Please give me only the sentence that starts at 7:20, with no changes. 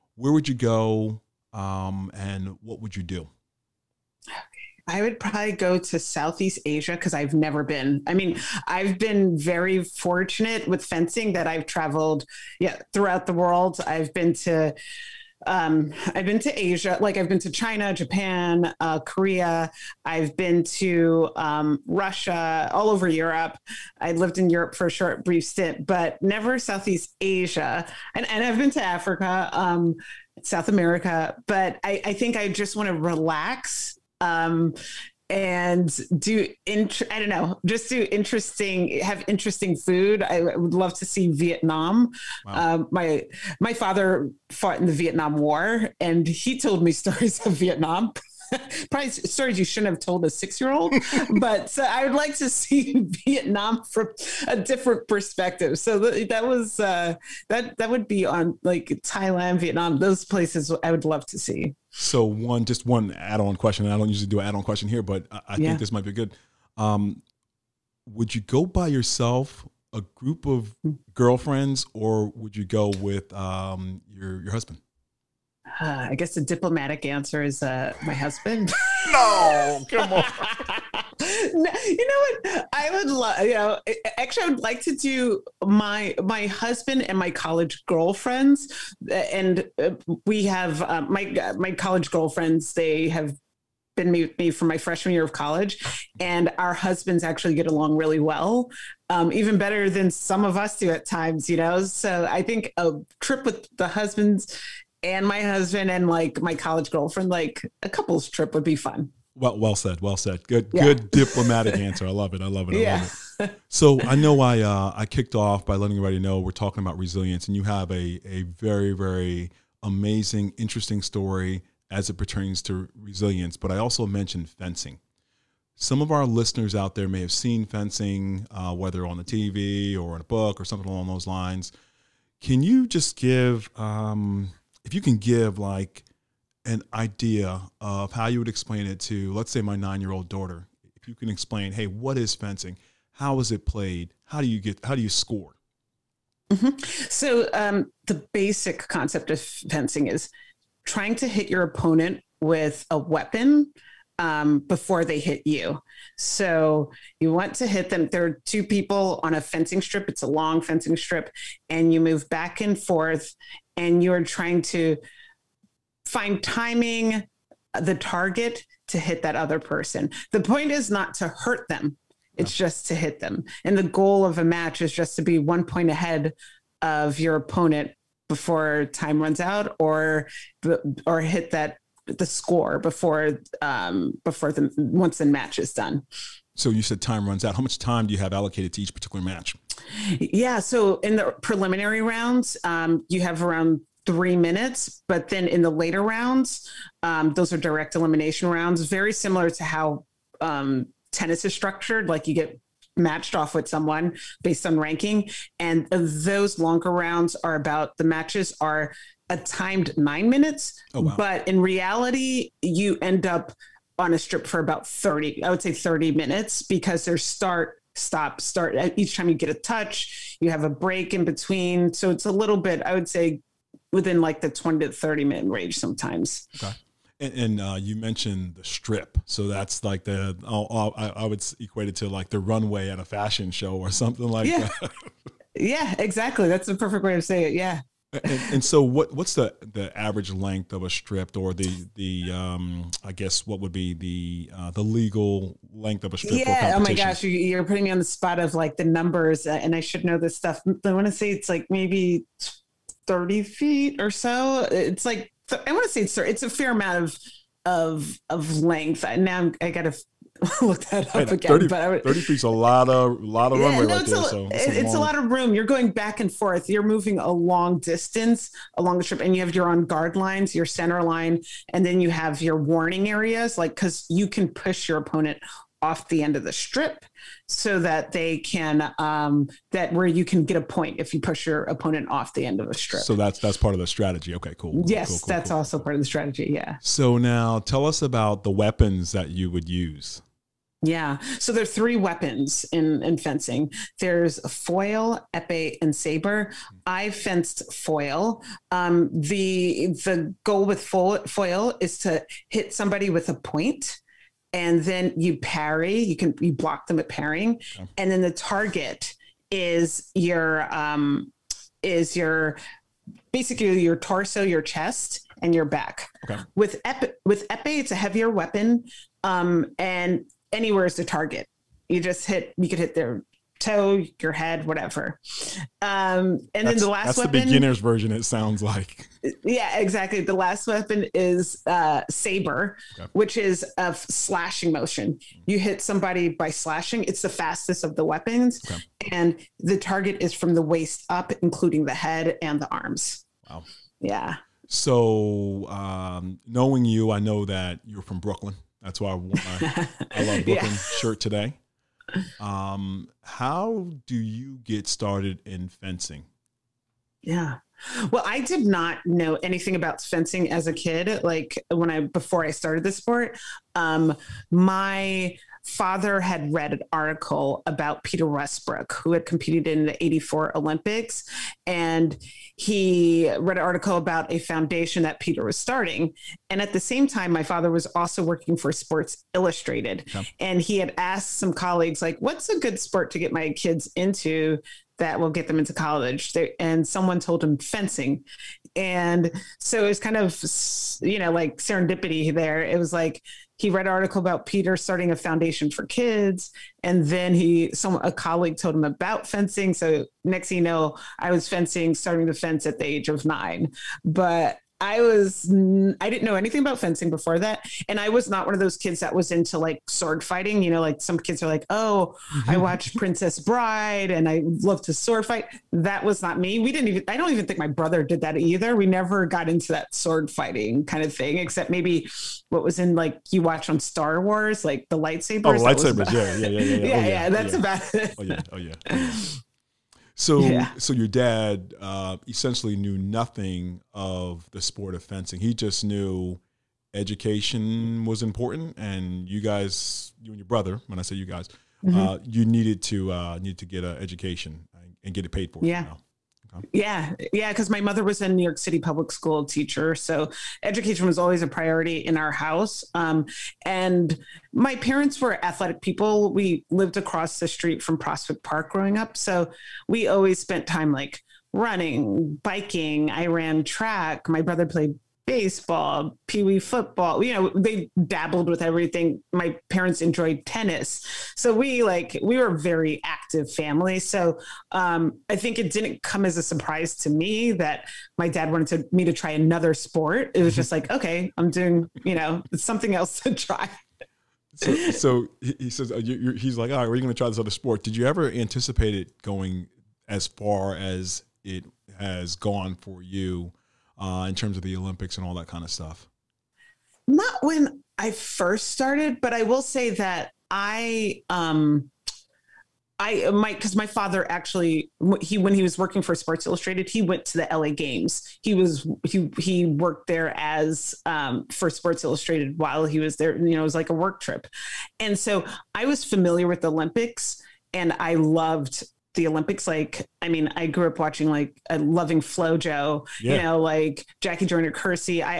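When I say you guys, mm -hmm.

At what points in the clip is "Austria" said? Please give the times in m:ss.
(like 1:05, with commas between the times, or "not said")
not said.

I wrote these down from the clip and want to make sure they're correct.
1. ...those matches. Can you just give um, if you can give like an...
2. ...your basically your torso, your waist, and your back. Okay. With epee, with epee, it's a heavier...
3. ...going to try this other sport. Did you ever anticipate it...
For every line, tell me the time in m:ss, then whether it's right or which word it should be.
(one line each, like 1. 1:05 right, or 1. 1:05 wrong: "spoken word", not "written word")
1. 2:11 wrong: "lines", not "matches"
2. 5:12 wrong: "chest", not "waist"
3. 8:06 right.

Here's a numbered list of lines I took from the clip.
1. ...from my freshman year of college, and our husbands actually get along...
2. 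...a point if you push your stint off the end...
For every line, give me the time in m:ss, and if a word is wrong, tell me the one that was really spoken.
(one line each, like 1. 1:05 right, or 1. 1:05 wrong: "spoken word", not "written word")
1. 1:34 right
2. 4:40 wrong: "opponent", not "stint".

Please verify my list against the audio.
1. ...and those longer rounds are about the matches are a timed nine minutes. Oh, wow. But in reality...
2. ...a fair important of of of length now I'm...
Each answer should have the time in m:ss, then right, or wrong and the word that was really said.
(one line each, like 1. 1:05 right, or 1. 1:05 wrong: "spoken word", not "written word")
1. 3:25 right
2. 4:16 wrong: "amount", not "important".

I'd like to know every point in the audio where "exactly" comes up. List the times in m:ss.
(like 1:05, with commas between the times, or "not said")
3:55, 5:29.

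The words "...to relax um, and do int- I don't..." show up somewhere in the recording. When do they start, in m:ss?
0:32.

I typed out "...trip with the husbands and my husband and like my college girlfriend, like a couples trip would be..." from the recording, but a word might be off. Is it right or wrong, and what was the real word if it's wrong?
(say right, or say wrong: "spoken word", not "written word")
right.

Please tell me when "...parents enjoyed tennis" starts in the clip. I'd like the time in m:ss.
7:49.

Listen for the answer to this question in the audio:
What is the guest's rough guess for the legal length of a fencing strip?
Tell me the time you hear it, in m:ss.
4:13.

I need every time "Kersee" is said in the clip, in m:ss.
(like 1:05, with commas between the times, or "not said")
8:44.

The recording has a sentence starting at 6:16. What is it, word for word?
And at the same time, my father was also working for Sports Illustrated.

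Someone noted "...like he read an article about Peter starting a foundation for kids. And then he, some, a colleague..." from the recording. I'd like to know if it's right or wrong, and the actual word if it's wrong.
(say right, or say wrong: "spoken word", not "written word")
right.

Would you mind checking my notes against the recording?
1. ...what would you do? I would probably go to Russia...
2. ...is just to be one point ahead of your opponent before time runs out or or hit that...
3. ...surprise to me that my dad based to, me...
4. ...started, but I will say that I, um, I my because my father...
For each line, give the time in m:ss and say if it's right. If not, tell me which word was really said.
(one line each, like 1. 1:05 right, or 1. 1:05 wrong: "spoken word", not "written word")
1. 0:02 wrong: "Southeast", not "Russia"
2. 2:54 right
3. 7:56 wrong: "wanted", not "based"
4. 8:18 right.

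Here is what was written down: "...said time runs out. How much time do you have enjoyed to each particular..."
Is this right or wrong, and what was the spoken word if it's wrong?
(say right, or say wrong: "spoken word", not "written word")
wrong: "allocated", not "enjoyed".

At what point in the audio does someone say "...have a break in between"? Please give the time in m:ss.
3:40.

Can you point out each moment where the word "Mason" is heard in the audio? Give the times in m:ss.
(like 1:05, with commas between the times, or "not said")
not said.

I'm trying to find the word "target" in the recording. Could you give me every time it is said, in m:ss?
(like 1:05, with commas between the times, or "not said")
2:47, 5:08, 5:21, 5:39.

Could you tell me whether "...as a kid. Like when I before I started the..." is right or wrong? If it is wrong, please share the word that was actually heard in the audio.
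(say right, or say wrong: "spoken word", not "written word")
right.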